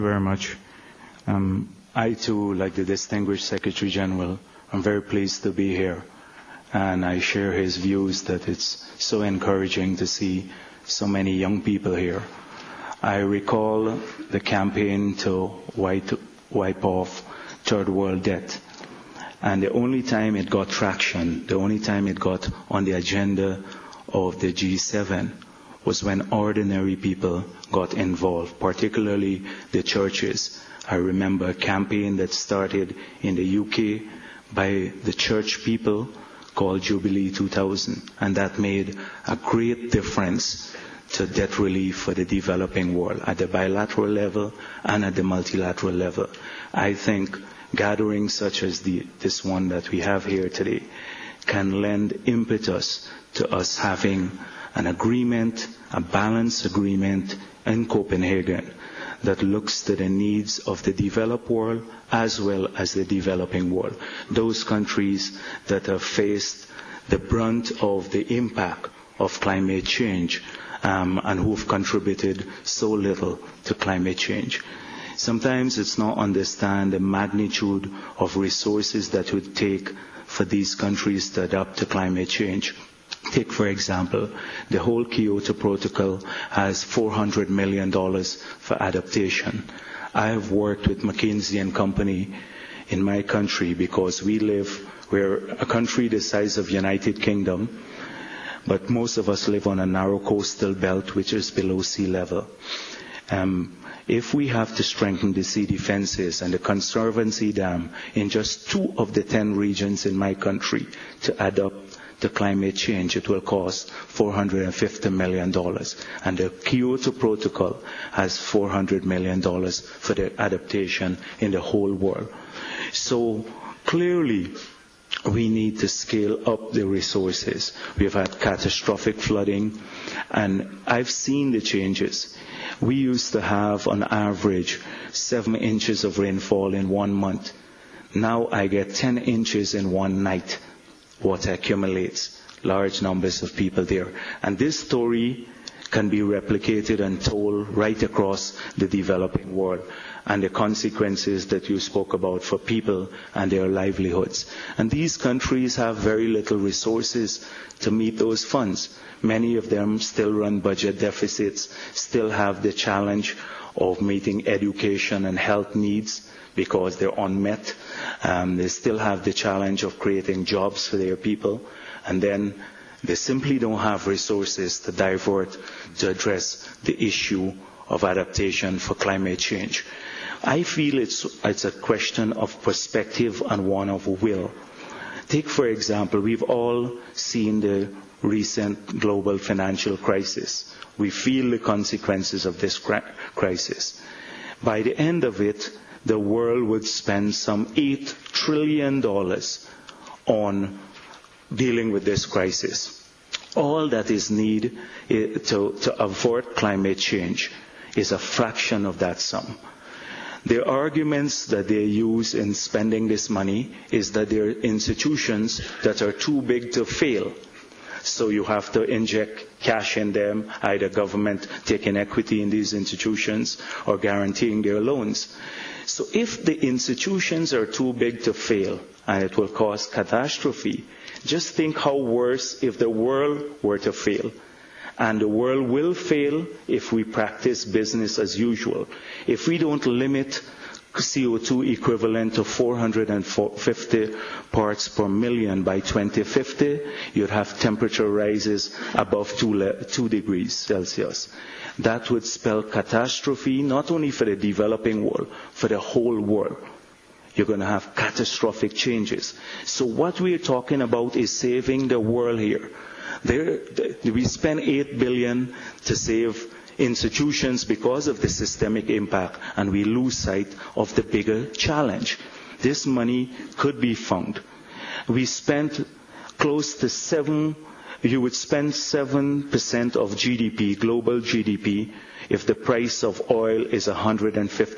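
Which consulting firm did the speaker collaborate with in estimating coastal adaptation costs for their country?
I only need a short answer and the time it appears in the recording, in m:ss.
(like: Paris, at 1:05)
McKinsey and Company, at 1:31.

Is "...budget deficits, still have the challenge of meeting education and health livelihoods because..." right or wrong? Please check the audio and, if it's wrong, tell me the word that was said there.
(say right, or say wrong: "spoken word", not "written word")
wrong: "needs", not "livelihoods".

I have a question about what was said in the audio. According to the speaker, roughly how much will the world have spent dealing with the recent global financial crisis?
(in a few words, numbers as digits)
$8 trillion.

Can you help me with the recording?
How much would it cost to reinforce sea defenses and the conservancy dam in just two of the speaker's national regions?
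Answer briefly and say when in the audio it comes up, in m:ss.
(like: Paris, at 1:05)
$450 million, at 1:53.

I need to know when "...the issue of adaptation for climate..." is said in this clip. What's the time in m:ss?
2:56.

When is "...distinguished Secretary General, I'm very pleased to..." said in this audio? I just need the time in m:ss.
0:02.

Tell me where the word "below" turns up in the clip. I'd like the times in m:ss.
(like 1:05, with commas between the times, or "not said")
1:41.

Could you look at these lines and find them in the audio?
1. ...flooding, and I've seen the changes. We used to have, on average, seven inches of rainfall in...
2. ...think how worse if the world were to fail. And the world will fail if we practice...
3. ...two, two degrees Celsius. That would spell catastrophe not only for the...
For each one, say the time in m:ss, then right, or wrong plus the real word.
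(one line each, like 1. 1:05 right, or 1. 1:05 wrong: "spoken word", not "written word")
1. 2:09 right
2. 3:51 right
3. 4:09 right.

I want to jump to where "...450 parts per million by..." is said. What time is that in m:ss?
4:02.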